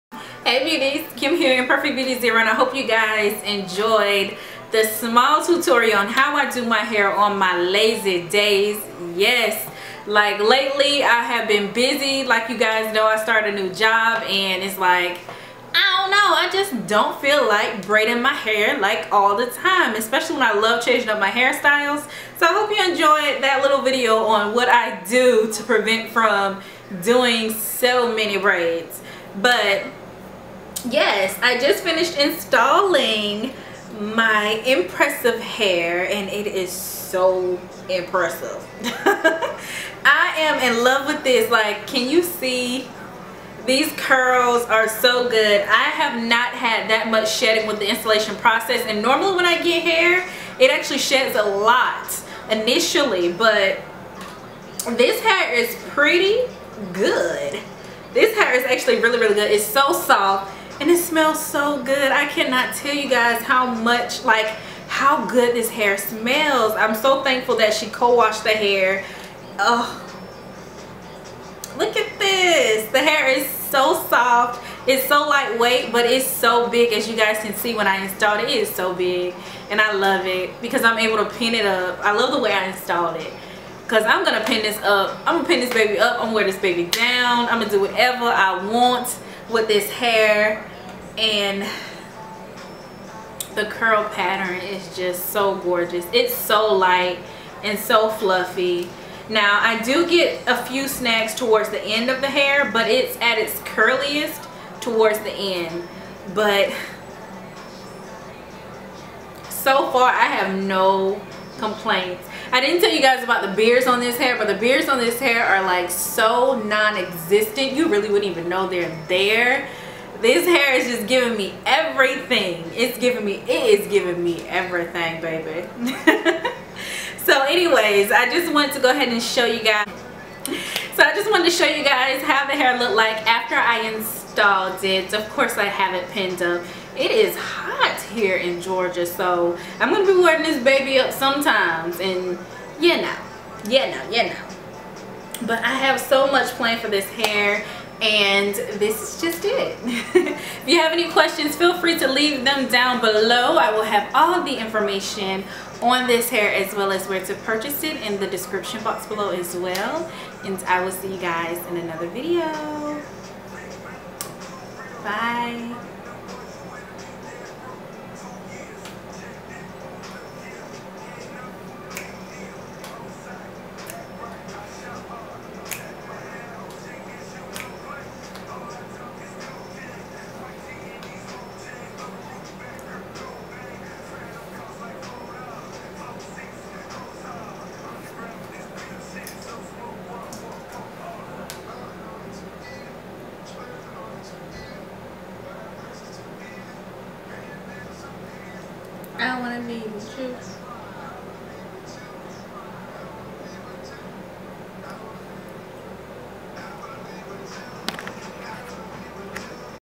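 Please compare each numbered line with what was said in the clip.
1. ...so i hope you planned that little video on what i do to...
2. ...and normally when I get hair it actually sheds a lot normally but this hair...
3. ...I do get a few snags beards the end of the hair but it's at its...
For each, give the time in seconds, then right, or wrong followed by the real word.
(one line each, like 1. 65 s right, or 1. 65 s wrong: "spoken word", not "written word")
1. 22 s wrong: "enjoyed", not "planned"
2. 48 s wrong: "initially", not "normally"
3. 99 s wrong: "towards", not "beards".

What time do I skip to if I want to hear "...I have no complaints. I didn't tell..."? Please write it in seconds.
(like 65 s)
110 s.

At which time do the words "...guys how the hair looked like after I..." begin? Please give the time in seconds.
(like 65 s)
131 s.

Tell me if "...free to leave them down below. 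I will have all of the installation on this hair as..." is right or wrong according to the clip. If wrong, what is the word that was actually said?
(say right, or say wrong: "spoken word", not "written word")
wrong: "information", not "installation".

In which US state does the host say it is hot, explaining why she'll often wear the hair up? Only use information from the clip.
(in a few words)
Georgia.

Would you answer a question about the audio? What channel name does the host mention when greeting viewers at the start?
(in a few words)
Perfect Beauty Zero.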